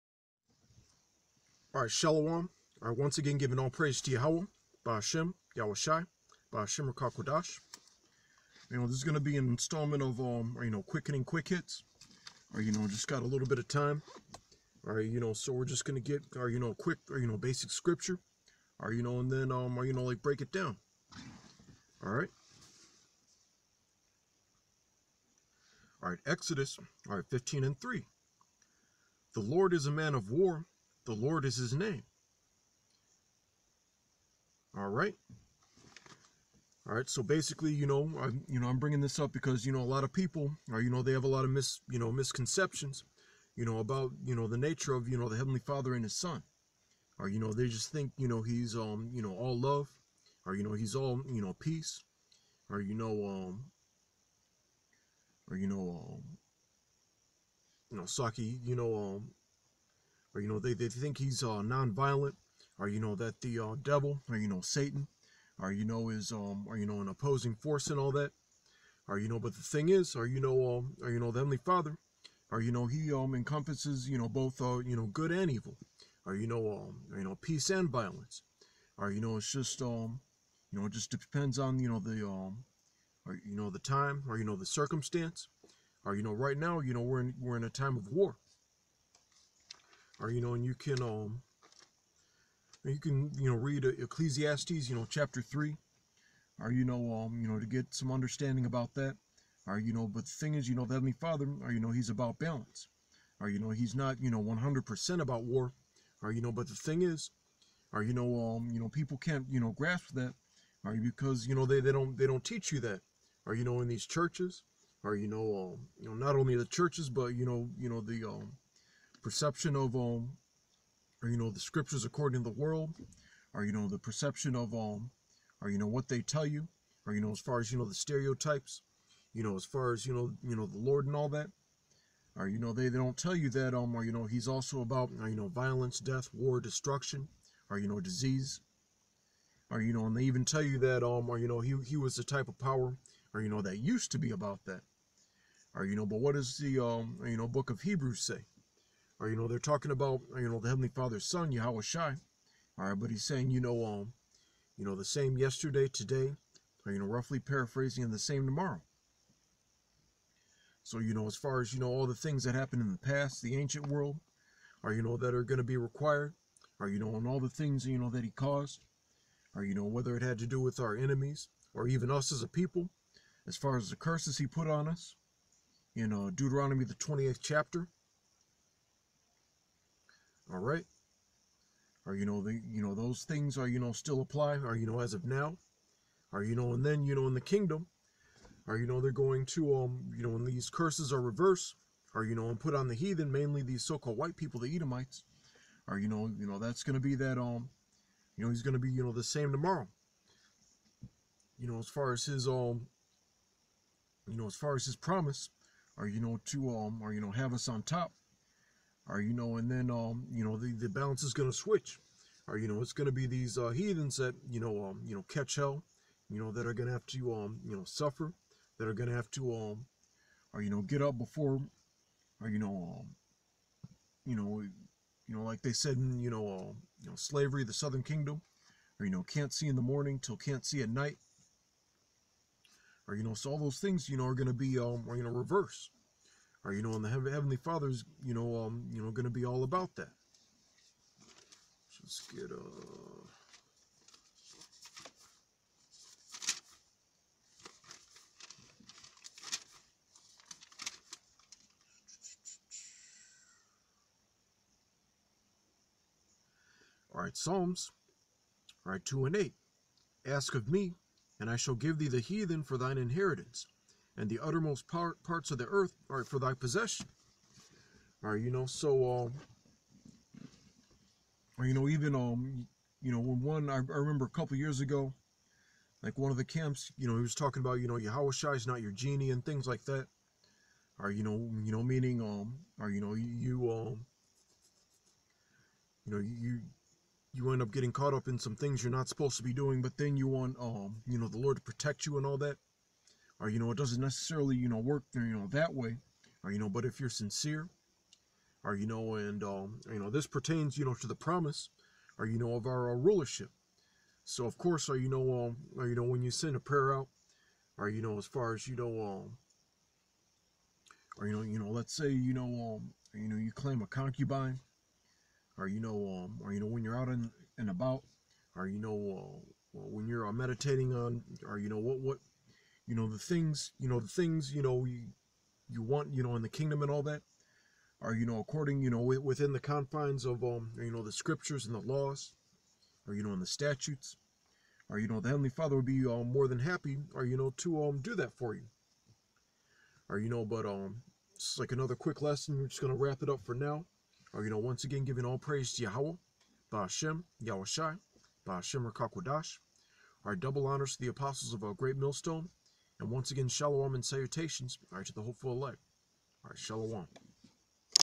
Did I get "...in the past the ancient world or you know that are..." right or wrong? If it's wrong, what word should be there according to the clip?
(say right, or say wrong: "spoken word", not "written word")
right.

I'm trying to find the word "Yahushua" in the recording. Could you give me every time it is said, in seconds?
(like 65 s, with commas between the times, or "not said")
277 s.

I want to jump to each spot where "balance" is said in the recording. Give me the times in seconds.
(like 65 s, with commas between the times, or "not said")
102 s, 210 s.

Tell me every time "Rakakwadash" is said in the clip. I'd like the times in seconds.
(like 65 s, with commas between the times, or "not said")
6 s, 348 s.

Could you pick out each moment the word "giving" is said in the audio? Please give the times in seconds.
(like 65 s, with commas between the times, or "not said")
3 s, 345 s.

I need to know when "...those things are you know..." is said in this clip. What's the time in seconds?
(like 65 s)
182 s.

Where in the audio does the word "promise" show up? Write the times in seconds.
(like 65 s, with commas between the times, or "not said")
204 s, 301 s.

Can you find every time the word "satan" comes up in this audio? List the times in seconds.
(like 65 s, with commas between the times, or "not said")
64 s.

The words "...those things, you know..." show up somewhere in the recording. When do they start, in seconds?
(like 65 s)
233 s.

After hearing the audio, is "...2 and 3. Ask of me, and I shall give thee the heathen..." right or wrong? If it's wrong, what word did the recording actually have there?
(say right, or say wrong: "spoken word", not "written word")
wrong: "8", not "3".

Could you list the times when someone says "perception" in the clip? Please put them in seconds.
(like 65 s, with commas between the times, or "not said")
119 s, 123 s.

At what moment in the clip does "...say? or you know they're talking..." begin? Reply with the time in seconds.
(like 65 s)
148 s.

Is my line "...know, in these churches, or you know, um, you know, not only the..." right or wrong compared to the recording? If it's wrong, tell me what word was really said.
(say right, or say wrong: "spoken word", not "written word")
right.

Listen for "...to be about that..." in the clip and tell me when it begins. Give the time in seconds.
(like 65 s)
144 s.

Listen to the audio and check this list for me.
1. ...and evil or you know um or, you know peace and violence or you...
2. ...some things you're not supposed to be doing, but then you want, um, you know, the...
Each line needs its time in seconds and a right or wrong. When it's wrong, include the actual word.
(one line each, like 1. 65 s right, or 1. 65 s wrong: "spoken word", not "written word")
1. 75 s right
2. 288 s right.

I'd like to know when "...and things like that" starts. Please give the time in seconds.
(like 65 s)
279 s.